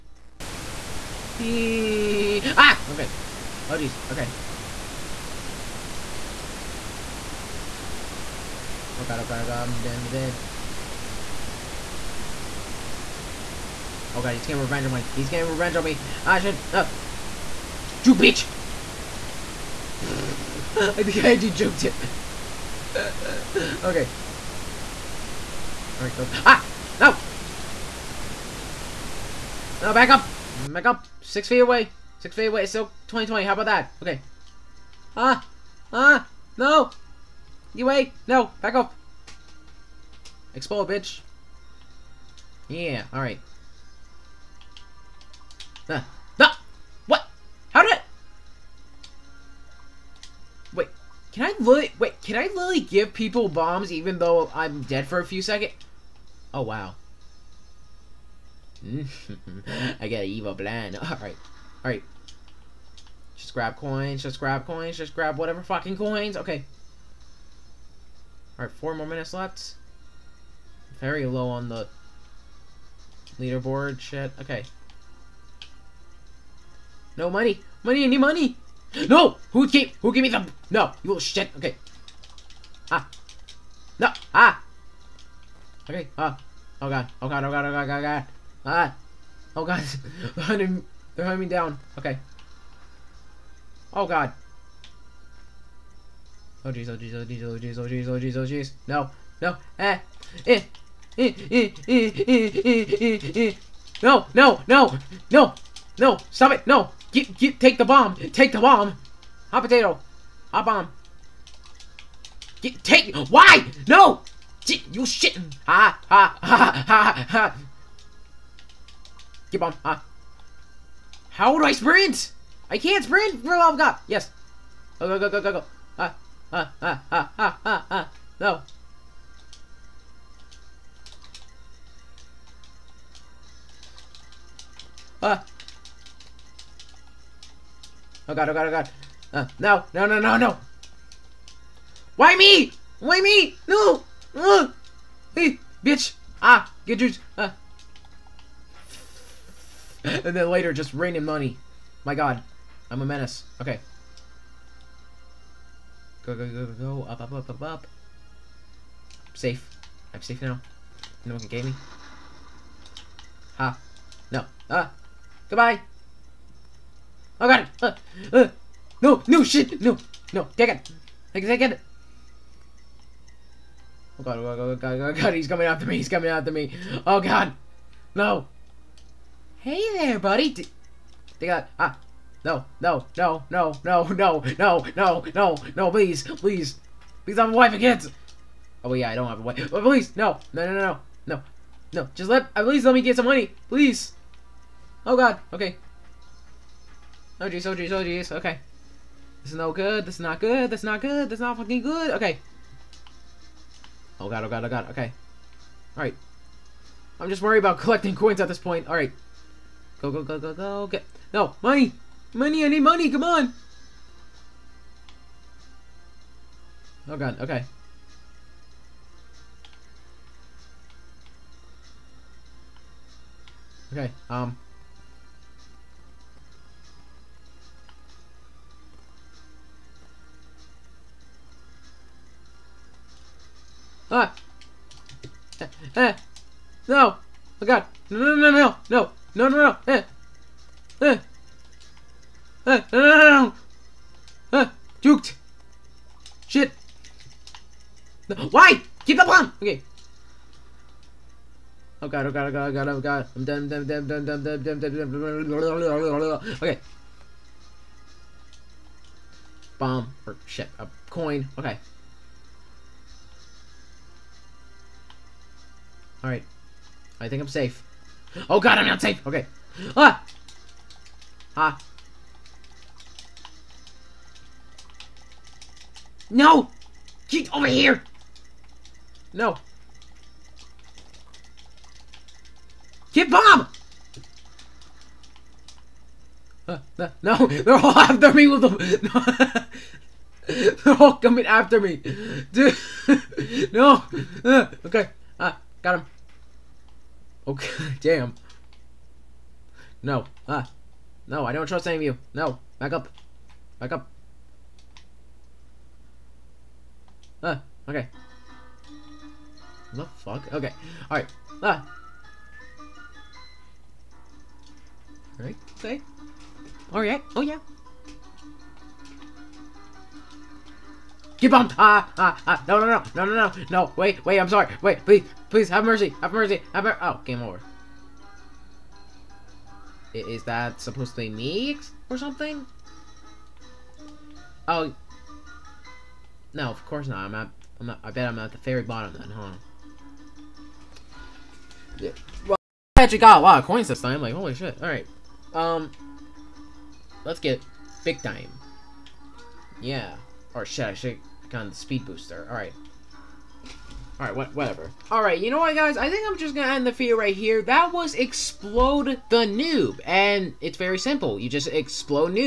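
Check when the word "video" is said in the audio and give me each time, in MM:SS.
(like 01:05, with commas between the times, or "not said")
05:56.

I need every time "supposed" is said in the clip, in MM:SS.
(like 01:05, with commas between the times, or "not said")
05:30.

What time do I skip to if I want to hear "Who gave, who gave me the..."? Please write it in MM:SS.
01:19.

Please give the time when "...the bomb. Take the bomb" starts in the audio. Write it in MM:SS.
01:47.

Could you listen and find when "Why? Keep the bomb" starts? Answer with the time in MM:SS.
04:08.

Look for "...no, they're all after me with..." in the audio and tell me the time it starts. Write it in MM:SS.
04:47.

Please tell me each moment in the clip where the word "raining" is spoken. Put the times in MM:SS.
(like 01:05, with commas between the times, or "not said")
02:30.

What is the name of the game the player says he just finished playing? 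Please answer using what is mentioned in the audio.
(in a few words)
Explode the Noob.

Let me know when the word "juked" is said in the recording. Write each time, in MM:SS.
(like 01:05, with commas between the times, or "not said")
00:21, 04:05.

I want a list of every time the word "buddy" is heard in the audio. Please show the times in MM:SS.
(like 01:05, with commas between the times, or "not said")
03:00.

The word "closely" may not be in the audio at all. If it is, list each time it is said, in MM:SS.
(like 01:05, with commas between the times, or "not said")
not said.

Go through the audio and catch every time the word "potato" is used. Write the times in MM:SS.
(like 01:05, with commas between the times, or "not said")
01:49.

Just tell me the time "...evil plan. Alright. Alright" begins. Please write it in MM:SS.
01:00.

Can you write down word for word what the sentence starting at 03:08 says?
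Oh, yeah, I don't have a wife.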